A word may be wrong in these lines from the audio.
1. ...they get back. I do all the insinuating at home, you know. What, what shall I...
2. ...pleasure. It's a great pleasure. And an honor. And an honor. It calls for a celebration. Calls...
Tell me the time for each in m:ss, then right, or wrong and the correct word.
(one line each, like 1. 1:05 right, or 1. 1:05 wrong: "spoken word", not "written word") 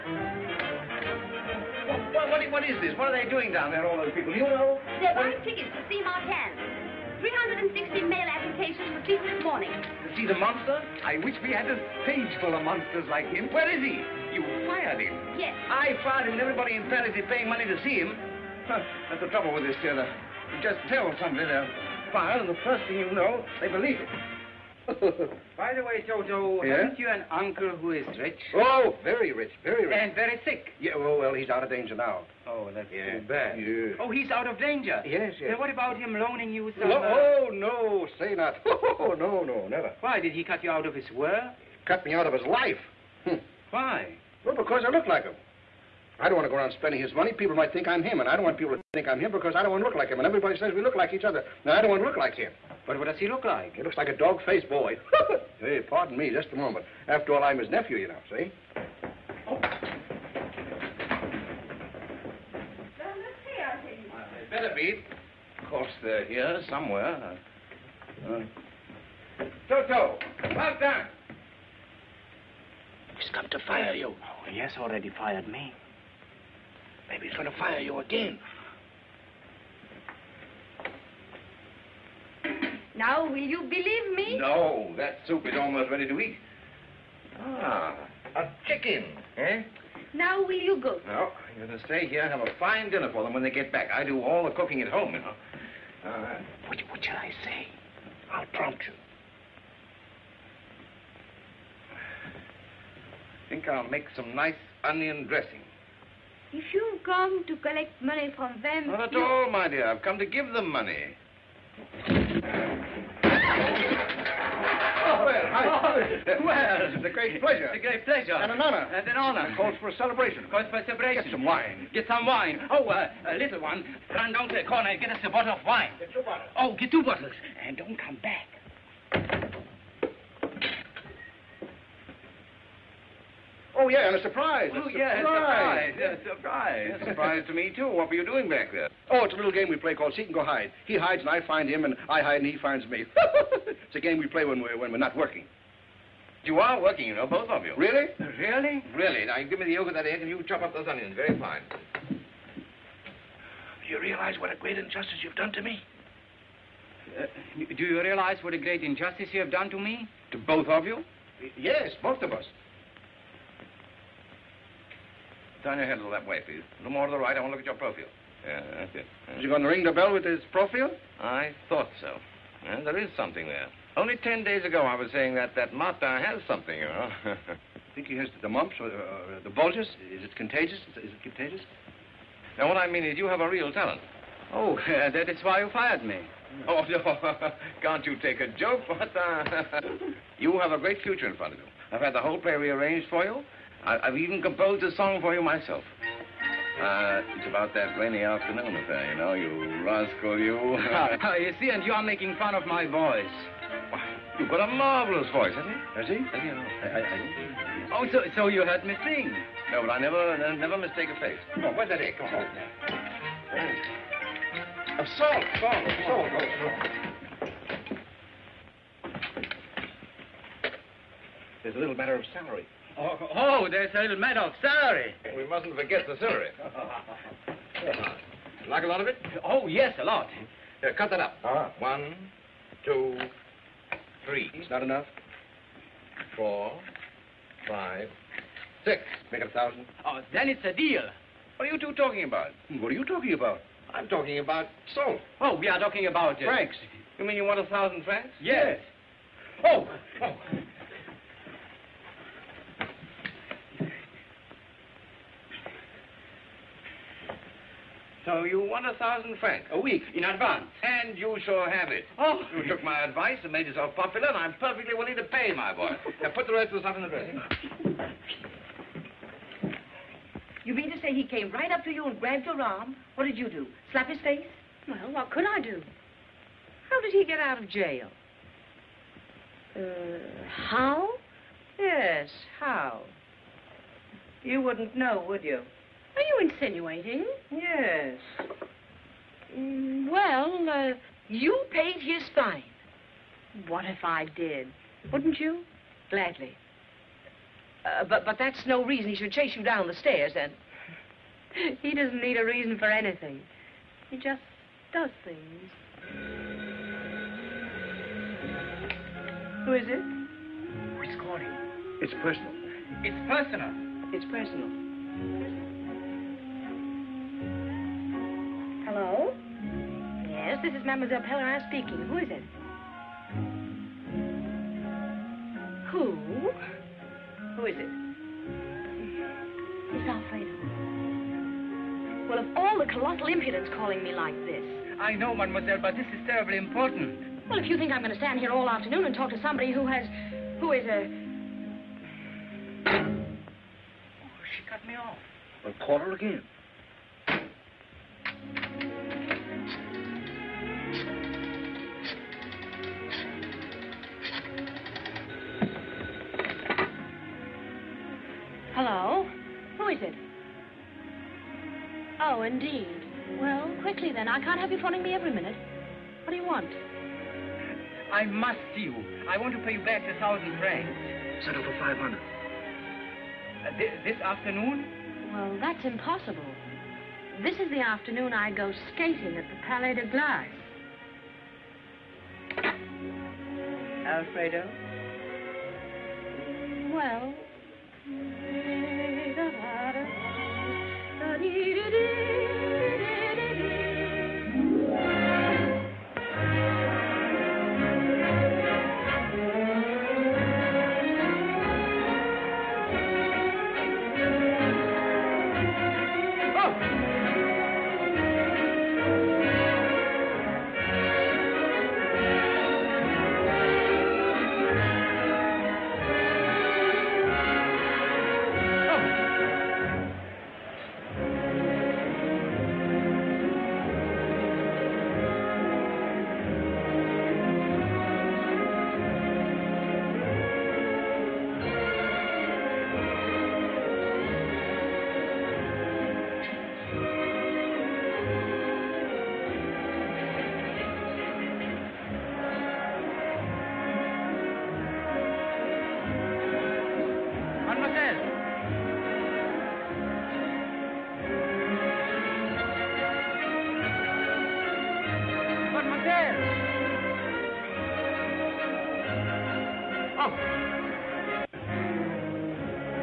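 1. 1:33 wrong: "cooking", not "insinuating"
2. 1:57 right.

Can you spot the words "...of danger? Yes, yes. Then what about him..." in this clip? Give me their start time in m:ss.
0:34.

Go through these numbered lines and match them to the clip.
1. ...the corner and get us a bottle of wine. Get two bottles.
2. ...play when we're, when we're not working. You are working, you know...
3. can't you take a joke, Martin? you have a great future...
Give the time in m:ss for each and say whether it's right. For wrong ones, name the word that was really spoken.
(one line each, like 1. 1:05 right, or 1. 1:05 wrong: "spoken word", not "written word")
1. 2:04 right
2. 2:24 right
3. 3:07 right.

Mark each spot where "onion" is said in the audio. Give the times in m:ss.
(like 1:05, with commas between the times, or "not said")
1:44, 2:30.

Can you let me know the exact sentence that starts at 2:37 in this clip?
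Uh, do you realize what a great injustice you have done to me?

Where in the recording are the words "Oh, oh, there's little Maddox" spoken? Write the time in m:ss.
3:43.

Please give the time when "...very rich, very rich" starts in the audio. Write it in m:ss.
0:29.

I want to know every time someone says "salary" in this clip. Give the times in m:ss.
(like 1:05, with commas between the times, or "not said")
3:42.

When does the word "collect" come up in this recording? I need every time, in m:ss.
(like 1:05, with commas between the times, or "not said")
1:47.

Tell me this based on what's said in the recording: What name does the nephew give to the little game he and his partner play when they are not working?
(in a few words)
Seek and Go Hide.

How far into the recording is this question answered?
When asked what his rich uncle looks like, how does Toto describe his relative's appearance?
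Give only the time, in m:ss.
0:54.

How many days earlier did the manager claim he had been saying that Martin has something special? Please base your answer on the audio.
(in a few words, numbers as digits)
10.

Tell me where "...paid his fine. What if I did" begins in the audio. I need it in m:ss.
4:51.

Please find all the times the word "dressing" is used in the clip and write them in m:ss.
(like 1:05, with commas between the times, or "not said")
1:45, 4:27.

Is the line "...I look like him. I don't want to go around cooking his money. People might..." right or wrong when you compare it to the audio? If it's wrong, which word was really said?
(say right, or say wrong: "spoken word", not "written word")
wrong: "spending", not "cooking".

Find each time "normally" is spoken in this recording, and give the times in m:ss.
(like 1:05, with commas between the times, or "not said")
not said.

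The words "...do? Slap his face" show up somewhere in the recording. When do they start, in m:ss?
4:33.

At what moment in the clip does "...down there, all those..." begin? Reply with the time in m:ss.
0:03.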